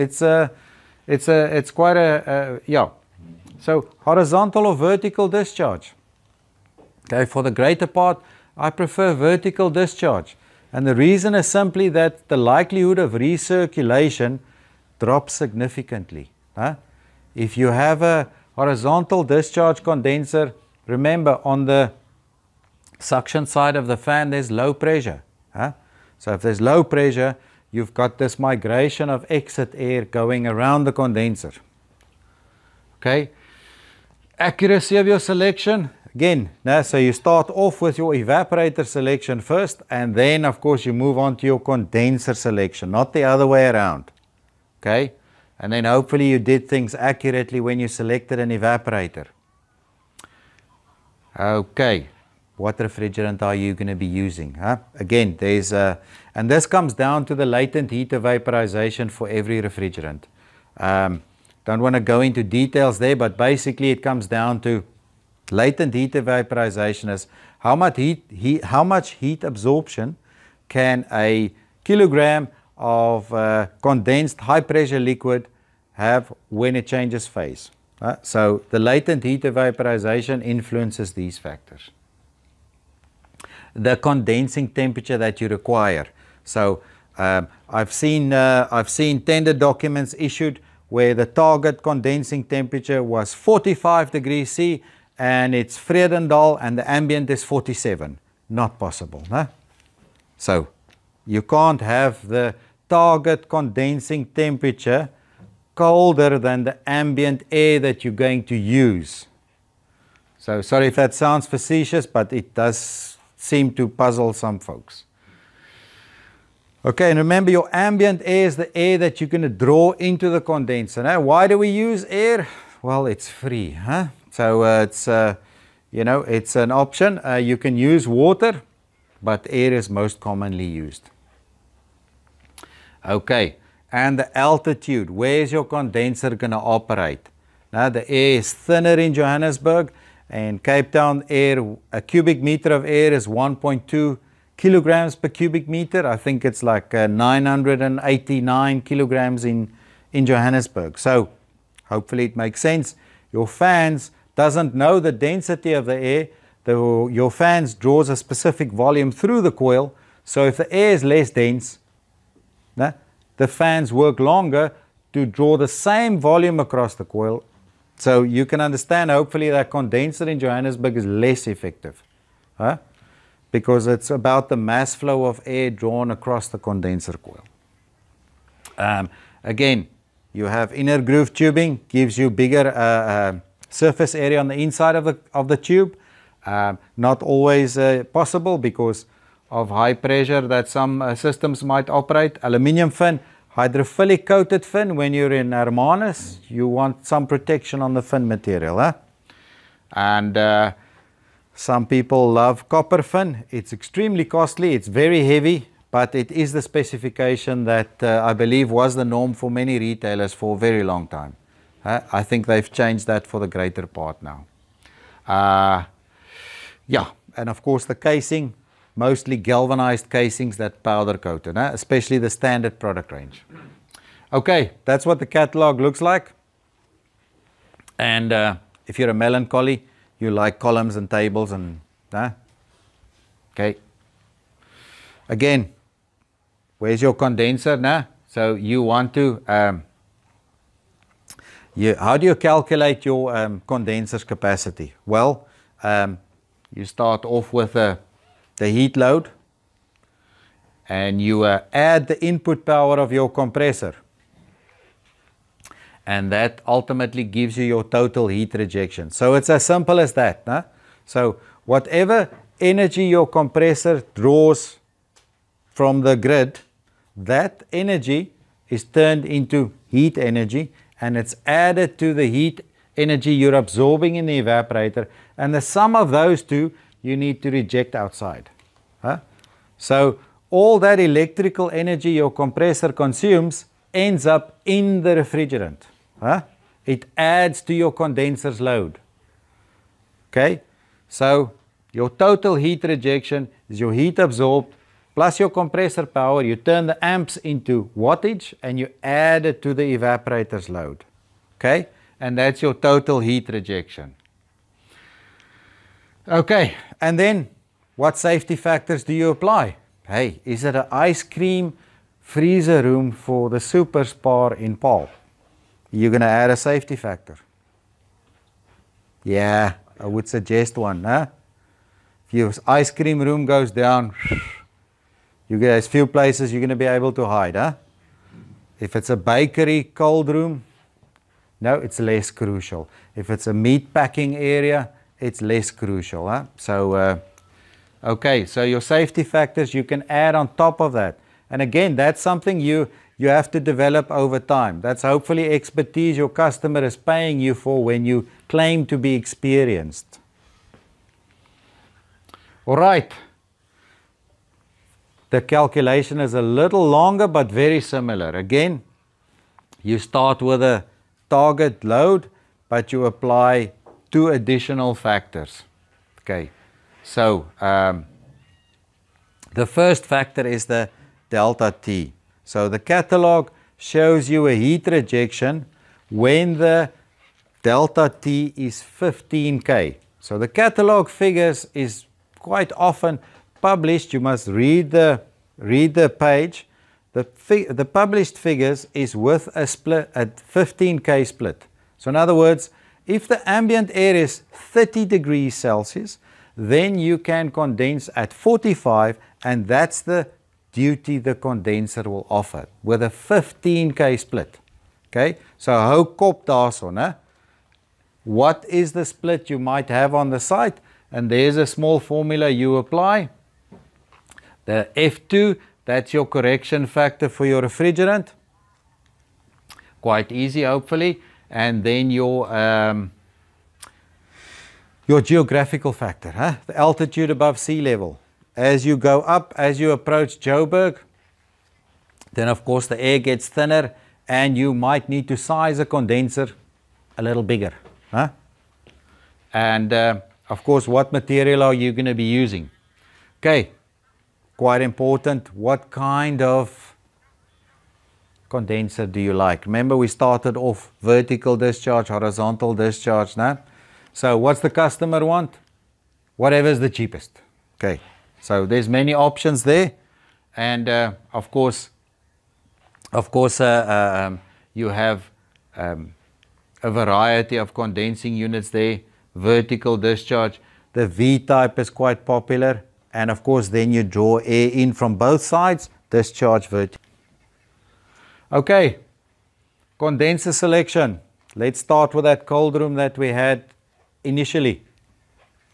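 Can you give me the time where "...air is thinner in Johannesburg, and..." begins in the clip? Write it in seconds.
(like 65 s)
138 s.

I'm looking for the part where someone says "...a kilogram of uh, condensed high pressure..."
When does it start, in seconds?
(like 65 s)
71 s.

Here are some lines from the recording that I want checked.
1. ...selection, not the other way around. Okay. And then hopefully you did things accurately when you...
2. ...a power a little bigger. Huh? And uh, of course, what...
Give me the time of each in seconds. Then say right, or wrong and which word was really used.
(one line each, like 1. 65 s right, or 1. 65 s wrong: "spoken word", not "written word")
1. 42 s right
2. 435 s wrong: "condenser", not "power".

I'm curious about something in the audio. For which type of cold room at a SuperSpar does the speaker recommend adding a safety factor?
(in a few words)
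Ice cream freezer room.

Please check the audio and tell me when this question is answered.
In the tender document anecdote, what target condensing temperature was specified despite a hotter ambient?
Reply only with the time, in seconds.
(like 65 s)
93 s.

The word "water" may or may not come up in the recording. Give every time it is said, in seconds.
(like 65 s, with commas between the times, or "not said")
128 s.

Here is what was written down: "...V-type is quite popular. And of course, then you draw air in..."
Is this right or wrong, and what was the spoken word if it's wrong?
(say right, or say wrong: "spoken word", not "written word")
right.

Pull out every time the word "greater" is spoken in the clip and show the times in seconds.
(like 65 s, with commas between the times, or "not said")
7 s, 213 s.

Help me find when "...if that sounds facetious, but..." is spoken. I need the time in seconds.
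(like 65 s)
110 s.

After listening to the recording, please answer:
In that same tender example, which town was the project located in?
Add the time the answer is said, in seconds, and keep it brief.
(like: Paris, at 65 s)
Vredendal, at 95 s.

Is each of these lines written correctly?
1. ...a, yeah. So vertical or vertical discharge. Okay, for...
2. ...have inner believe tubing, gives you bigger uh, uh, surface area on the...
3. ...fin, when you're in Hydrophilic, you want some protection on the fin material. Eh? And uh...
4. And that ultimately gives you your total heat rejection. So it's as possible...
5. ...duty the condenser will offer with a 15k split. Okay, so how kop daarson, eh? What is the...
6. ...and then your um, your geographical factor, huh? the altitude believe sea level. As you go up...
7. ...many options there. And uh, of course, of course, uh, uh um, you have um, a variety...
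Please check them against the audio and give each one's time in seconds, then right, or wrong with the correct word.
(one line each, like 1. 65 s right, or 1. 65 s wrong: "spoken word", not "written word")
1. 2 s wrong: "horizontal", not "vertical"
2. 180 s wrong: "groove", not "believe"
3. 194 s wrong: "Hermanus", not "Hydrophilic"
4. 256 s wrong: "simple", not "possible"
5. 400 s right
6. 421 s wrong: "above", not "believe"
7. 458 s right.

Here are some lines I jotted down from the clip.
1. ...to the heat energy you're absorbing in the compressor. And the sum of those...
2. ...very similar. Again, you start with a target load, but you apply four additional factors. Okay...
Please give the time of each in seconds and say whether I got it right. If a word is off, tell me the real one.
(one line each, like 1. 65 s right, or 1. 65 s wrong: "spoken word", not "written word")
1. 271 s wrong: "evaporator", not "compressor"
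2. 357 s wrong: "two", not "four".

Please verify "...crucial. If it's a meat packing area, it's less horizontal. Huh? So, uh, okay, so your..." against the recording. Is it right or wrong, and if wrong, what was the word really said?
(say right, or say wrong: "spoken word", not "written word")
wrong: "crucial", not "horizontal".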